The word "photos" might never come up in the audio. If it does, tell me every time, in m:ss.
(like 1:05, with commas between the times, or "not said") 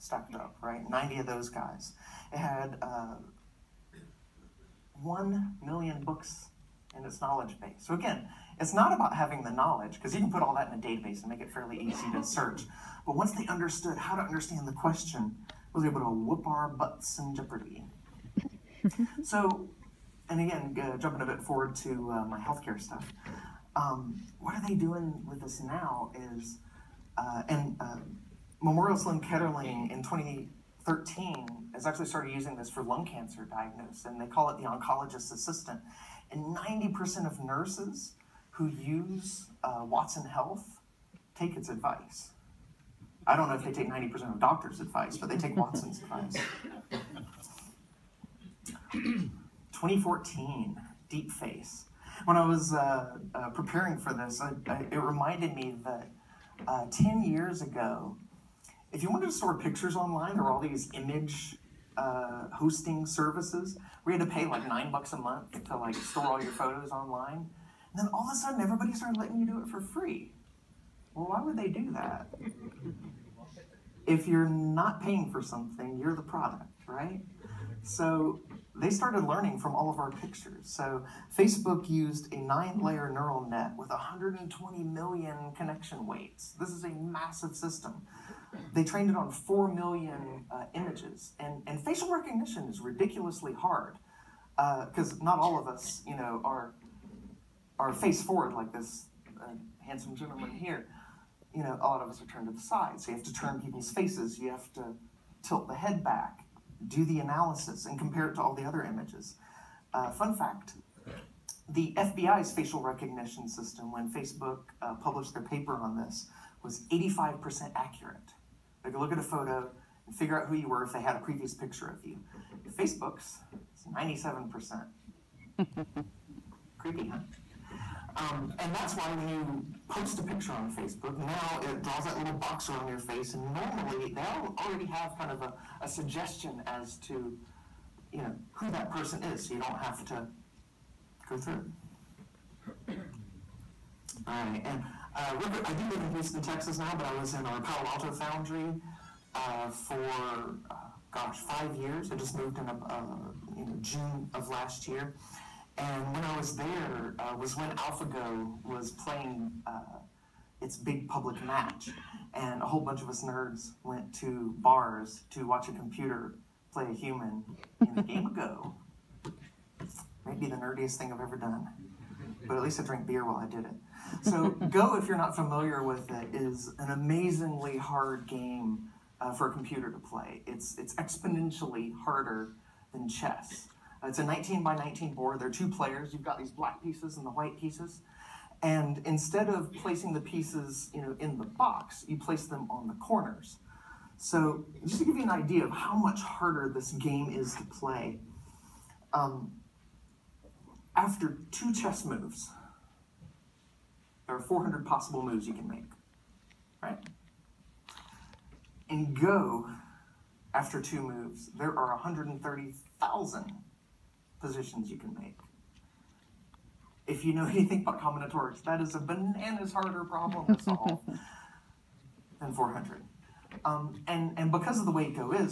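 1:06, 1:59.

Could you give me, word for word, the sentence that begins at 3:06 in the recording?
You've got these black pieces and the white pieces.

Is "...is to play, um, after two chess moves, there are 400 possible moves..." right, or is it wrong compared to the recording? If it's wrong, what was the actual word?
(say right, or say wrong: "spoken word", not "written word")
right.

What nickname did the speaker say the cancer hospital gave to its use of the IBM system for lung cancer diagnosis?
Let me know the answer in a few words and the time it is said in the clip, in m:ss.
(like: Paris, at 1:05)
oncologist's assistant, at 0:34.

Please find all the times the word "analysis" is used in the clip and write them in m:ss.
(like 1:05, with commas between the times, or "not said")
1:47.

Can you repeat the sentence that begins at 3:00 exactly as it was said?
It's it's exponentially harder than chess.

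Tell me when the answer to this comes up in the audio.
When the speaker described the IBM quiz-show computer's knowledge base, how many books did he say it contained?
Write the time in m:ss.
0:05.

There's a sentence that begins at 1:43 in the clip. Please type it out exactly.
So you have to turn people's faces.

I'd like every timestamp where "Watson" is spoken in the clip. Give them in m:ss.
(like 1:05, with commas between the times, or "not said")
0:39, 0:45.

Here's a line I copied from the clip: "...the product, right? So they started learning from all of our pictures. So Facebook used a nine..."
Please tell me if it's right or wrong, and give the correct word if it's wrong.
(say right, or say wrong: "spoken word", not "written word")
right.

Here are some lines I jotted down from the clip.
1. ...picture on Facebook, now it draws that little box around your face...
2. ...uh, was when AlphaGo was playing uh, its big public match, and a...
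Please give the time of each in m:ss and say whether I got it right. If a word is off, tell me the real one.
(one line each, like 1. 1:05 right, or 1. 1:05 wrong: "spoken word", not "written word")
1. 2:10 right
2. 2:37 right.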